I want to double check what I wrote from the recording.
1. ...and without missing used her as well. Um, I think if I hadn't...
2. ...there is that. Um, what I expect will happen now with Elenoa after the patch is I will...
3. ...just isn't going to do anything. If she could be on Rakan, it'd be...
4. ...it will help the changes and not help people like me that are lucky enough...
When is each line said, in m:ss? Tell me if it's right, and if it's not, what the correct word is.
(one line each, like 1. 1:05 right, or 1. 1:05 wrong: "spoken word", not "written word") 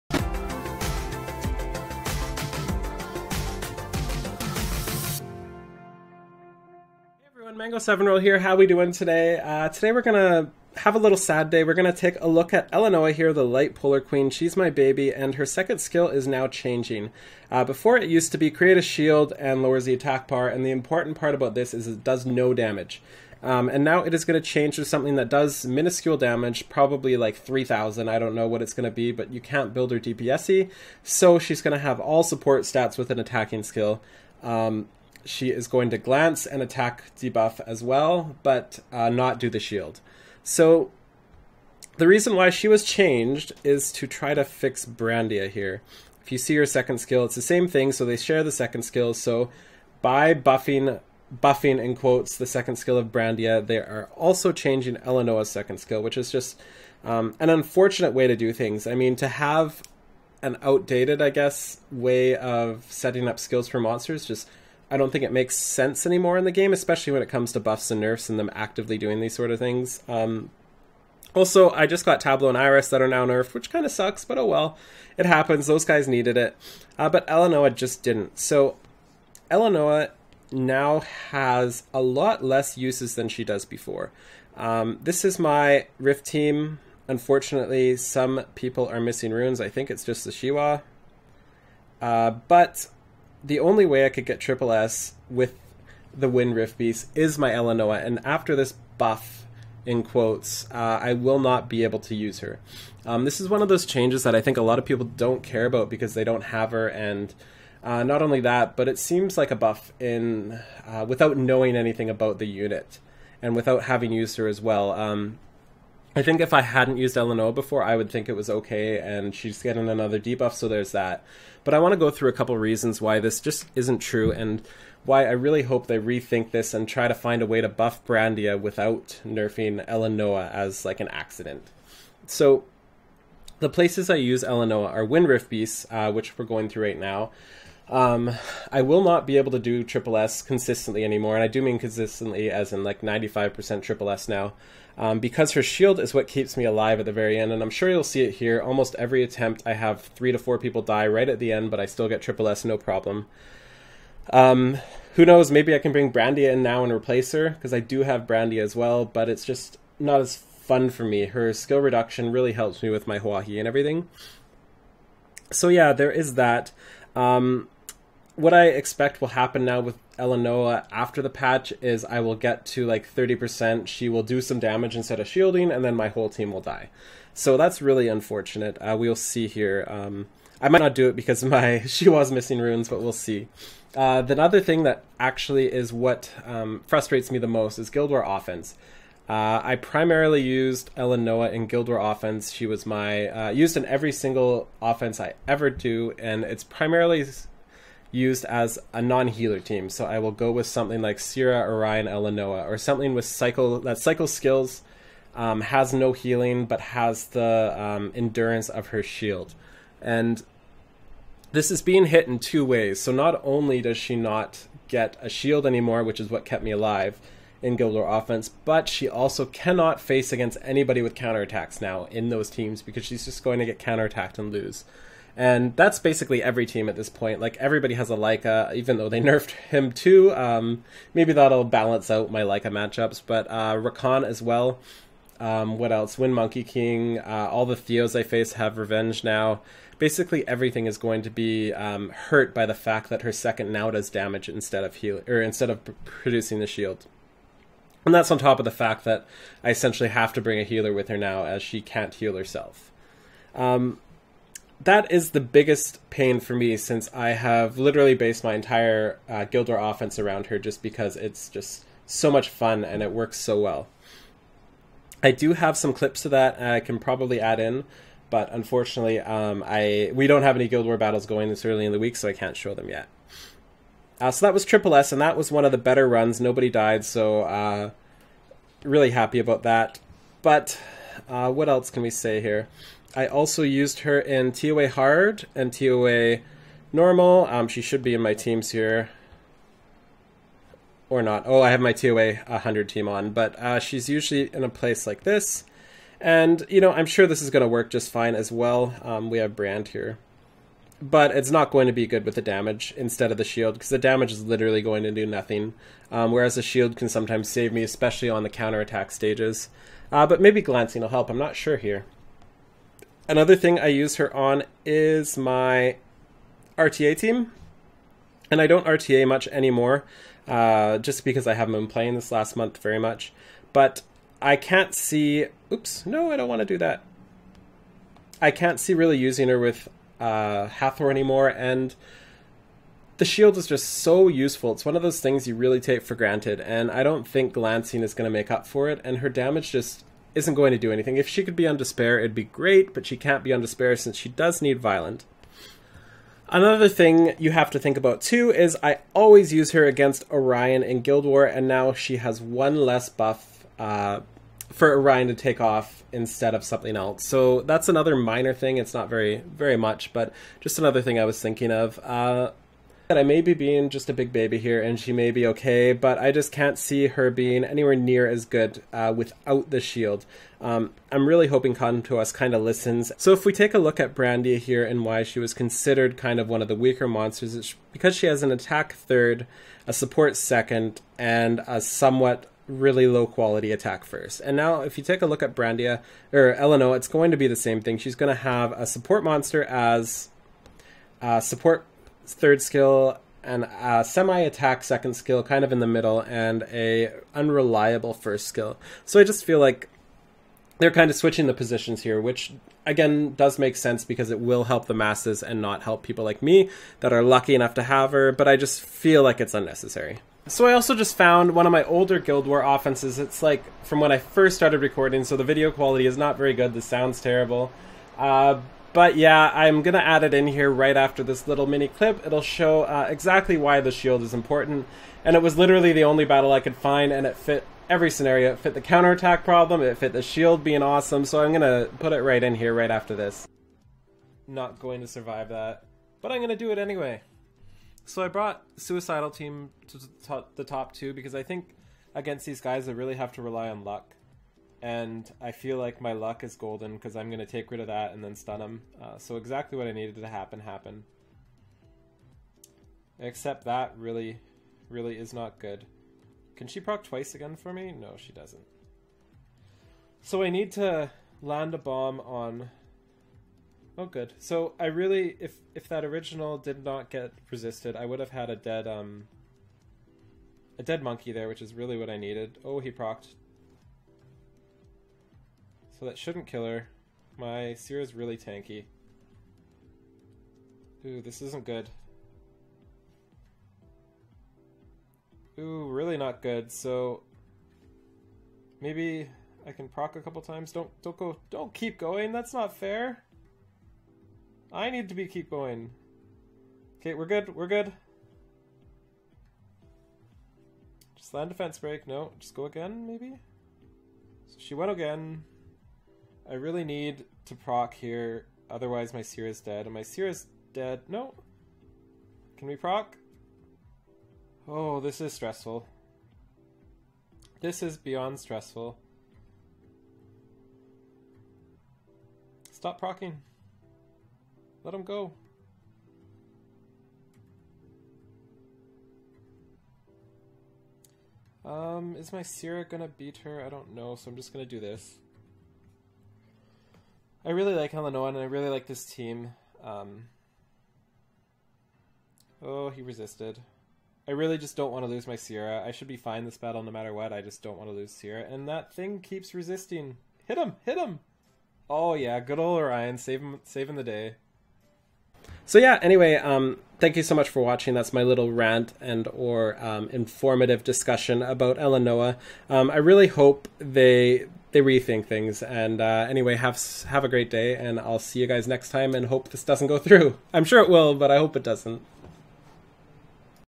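1. 1:53 wrong: "having", not "missing"
2. 2:45 right
3. 5:39 wrong: "Despair", not "Rakan"
4. 6:44 wrong: "masses", not "changes".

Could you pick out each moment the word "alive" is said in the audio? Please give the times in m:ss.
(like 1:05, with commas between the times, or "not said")
2:26, 3:36.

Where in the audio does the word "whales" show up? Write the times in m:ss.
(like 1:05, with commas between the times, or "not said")
not said.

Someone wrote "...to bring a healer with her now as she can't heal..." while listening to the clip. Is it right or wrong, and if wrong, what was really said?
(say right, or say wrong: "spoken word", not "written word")
right.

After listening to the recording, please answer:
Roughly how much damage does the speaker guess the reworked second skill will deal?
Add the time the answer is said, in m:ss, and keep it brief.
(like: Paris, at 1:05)
3,000, at 0:27.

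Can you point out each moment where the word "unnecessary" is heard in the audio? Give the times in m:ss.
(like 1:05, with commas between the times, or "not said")
6:49.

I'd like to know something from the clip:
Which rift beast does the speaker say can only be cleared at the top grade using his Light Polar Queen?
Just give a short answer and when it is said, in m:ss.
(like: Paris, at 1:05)
Wind Rift Beast, at 1:36.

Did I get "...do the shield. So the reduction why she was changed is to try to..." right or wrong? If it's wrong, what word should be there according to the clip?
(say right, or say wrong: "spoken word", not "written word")
wrong: "reason", not "reduction".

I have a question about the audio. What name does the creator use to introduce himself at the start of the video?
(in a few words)
Mango Seven Roll.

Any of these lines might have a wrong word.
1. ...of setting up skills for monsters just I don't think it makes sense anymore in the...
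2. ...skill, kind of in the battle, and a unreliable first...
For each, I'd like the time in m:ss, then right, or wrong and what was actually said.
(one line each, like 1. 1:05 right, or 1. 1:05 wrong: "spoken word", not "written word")
1. 1:02 right
2. 6:35 wrong: "middle", not "battle".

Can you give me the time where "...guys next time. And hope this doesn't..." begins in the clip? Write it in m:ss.
9:28.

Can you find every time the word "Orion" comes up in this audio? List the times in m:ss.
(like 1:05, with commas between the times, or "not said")
3:21, 5:50, 5:54, 9:12.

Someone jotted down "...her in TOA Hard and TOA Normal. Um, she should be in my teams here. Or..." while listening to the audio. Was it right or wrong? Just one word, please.
right.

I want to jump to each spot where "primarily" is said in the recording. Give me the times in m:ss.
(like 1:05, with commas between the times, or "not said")
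3:09, 3:16.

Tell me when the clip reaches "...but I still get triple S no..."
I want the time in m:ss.
2:31.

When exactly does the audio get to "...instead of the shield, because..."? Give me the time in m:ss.
5:02.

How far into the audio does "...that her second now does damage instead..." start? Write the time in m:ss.
4:03.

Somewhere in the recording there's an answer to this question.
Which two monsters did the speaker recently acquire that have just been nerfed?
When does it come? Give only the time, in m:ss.
1:12.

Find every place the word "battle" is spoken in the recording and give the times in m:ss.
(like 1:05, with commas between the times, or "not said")
4:30, 7:06, 9:06.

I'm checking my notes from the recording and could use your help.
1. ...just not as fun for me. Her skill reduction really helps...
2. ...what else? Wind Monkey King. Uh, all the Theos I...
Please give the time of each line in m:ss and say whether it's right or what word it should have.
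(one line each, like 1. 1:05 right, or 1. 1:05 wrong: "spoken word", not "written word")
1. 2:39 right
2. 3:55 right.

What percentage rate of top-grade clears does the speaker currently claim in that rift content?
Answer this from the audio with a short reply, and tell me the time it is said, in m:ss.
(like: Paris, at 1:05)
95%, at 2:23.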